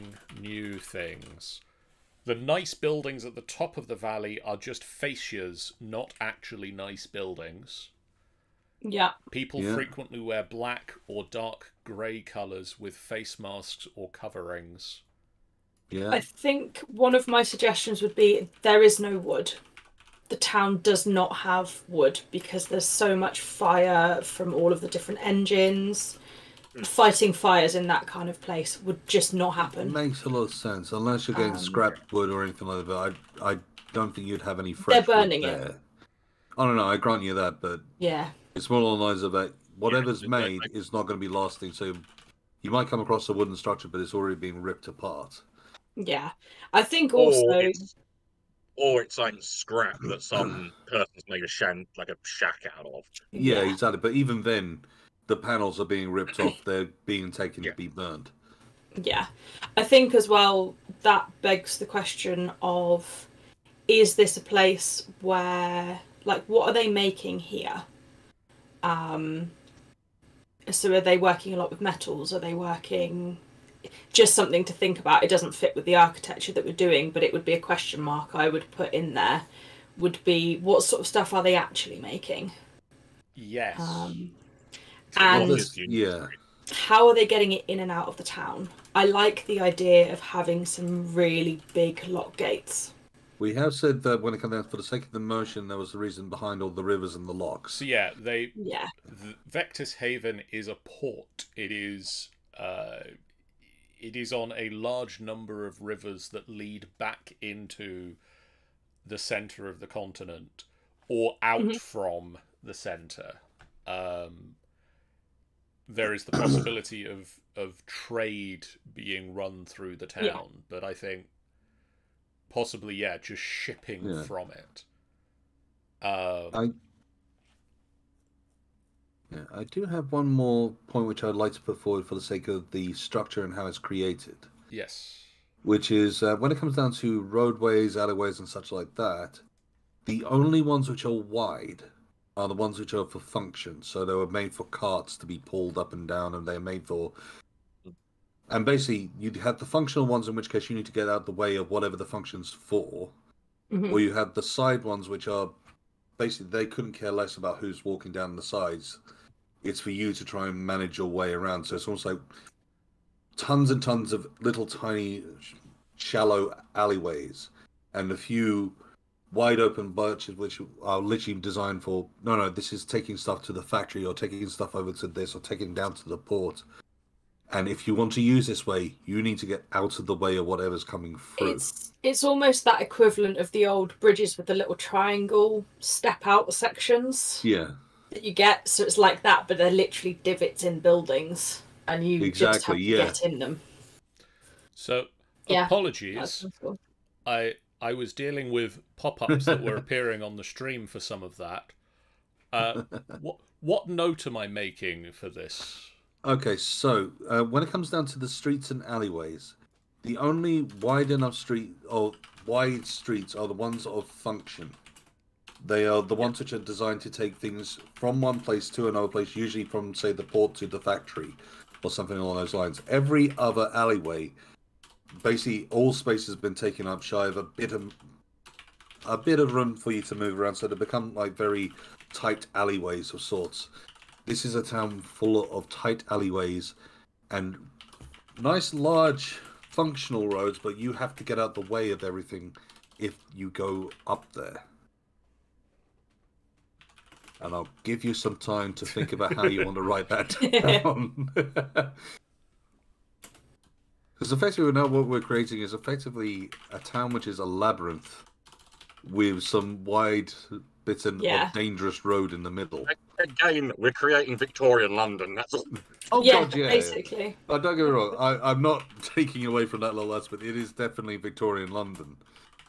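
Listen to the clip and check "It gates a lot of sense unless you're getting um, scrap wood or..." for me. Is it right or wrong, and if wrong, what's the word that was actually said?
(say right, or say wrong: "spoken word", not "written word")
wrong: "makes", not "gates".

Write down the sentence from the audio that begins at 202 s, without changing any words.
Uh, what what note am I making for this?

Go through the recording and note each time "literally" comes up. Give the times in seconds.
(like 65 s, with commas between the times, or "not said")
170 s, 189 s.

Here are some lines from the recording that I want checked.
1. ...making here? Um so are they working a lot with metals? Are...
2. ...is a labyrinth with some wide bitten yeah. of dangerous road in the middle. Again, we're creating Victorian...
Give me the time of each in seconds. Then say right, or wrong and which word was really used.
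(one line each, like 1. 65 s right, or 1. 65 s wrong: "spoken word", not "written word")
1. 66 s right
2. 257 s right.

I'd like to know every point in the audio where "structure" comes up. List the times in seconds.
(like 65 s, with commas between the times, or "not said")
43 s, 132 s.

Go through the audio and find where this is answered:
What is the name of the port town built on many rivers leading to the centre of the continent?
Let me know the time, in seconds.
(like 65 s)
99 s.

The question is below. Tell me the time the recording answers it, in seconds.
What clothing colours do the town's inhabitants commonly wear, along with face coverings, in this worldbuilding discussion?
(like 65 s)
10 s.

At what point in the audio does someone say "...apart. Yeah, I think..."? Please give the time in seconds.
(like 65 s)
44 s.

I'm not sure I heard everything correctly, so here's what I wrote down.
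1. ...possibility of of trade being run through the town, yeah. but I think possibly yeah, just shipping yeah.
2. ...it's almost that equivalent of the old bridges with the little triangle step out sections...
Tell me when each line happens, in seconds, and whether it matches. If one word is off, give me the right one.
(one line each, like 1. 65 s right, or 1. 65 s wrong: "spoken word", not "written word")
1. 116 s right
2. 182 s right.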